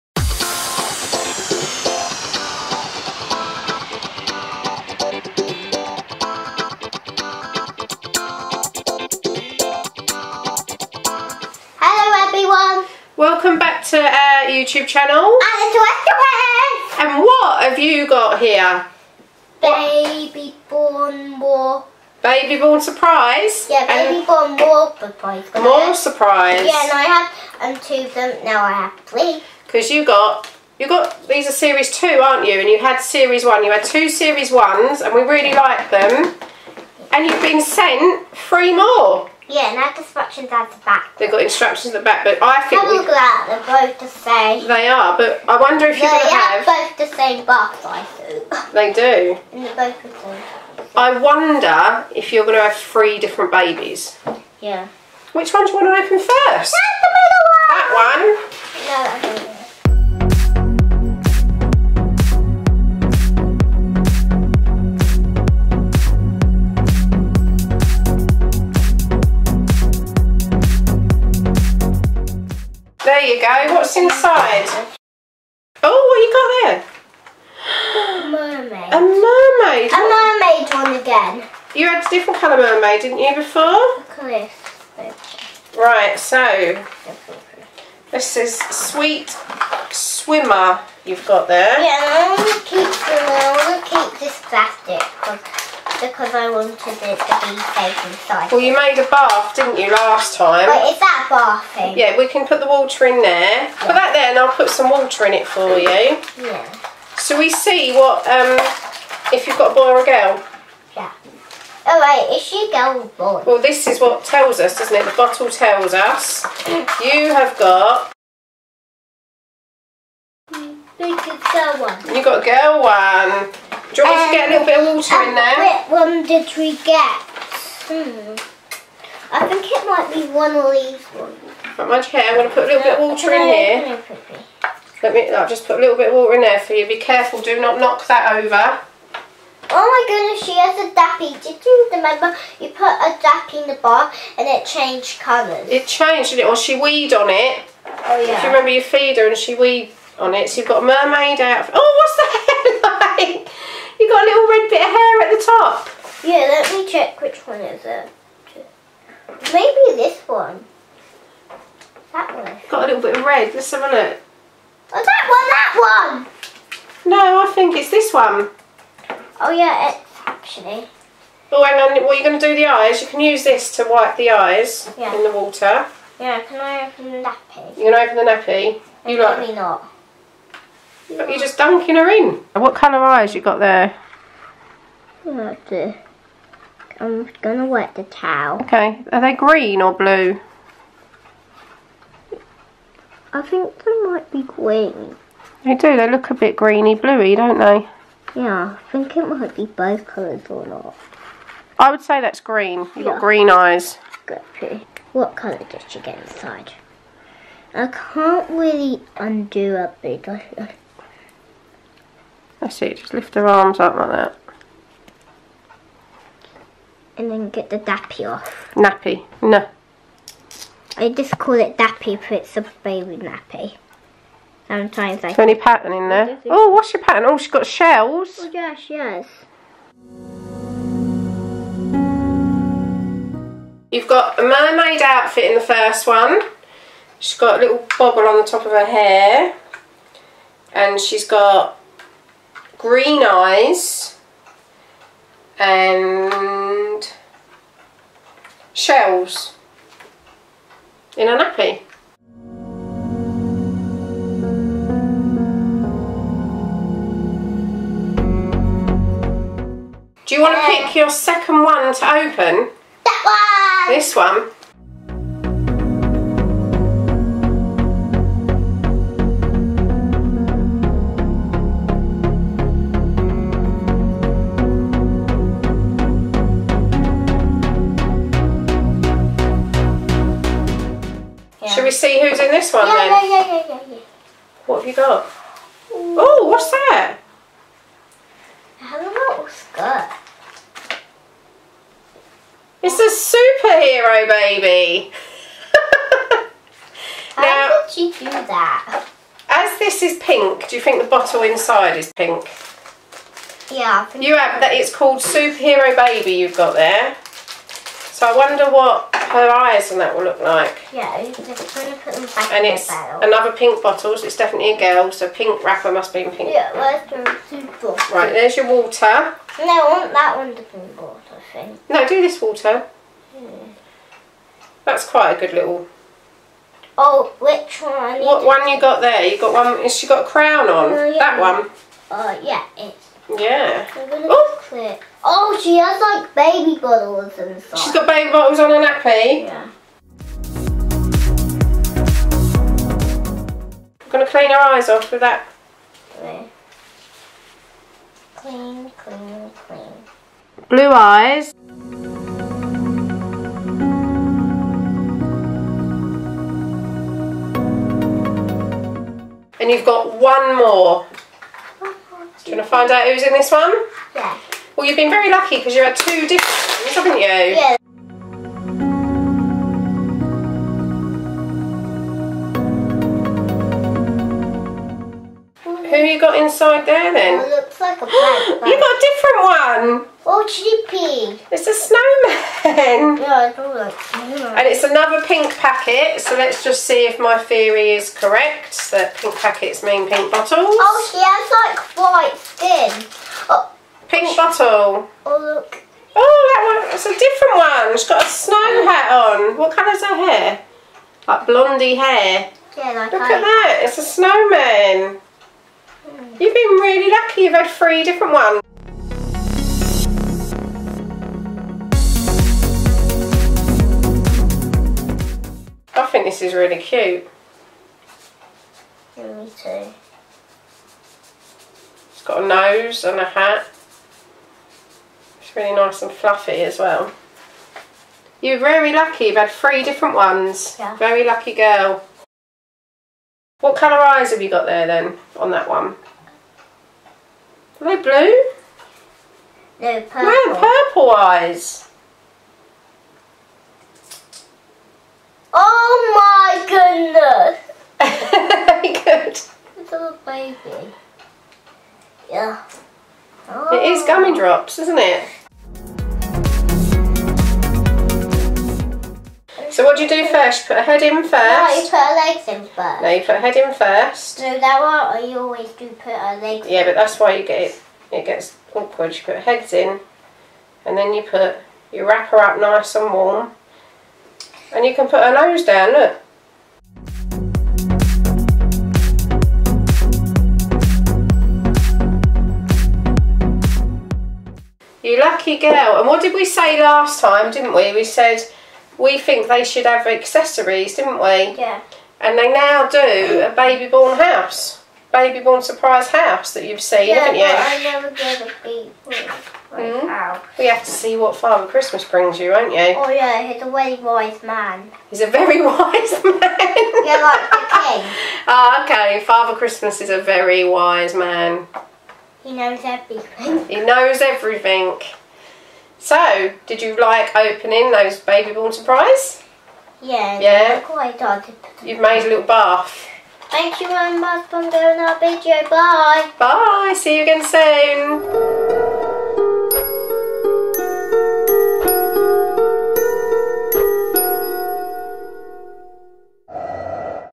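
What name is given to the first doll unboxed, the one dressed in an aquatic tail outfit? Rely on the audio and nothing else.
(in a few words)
Sweet swimmer.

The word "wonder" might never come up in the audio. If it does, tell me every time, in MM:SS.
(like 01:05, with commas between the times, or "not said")
00:45, 00:51, 05:08.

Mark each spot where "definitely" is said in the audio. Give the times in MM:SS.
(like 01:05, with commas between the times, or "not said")
05:14.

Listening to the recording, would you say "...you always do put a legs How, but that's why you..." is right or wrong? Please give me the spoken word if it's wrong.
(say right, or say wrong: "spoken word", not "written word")
wrong: "Yeah", not "How".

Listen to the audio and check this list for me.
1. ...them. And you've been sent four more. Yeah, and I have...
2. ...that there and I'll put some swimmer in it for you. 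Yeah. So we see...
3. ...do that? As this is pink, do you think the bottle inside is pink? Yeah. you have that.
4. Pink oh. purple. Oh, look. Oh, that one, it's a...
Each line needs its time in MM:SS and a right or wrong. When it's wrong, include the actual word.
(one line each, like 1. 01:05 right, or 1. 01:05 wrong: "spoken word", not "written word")
1. 00:35 wrong: "three", not "four"
2. 01:43 wrong: "water", not "swimmer"
3. 04:58 right
4. 06:34 wrong: "bottle", not "purple".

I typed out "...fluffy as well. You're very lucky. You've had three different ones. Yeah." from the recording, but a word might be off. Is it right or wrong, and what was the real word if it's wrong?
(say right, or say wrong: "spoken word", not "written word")
right.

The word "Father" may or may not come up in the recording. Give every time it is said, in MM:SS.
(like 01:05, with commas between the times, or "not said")
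08:21, 08:29.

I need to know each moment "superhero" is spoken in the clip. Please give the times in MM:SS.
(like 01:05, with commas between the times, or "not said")
04:53, 05:05.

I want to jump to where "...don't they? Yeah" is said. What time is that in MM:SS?
03:17.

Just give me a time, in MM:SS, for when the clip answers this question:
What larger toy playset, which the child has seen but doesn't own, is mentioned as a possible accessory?
08:15.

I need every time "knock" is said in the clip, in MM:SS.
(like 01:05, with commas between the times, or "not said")
02:17.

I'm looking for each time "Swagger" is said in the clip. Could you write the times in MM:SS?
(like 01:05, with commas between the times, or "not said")
not said.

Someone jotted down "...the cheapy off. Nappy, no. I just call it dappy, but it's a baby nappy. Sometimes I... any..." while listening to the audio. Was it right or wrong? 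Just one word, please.
wrong.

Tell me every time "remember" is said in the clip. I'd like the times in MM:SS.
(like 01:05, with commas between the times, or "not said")
02:21, 02:28.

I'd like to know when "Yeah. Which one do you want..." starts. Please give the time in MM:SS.
00:54.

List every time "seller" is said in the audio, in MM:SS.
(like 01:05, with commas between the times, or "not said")
not said.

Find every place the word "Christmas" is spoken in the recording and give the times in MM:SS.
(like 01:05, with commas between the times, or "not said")
08:21, 08:29.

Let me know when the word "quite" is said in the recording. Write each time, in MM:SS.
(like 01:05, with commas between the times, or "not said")
05:25, 08:40.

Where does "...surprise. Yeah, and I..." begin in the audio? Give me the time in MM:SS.
00:25.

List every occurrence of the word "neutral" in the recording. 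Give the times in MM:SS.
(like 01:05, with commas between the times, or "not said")
not said.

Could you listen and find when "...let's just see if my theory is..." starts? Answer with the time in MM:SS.
06:26.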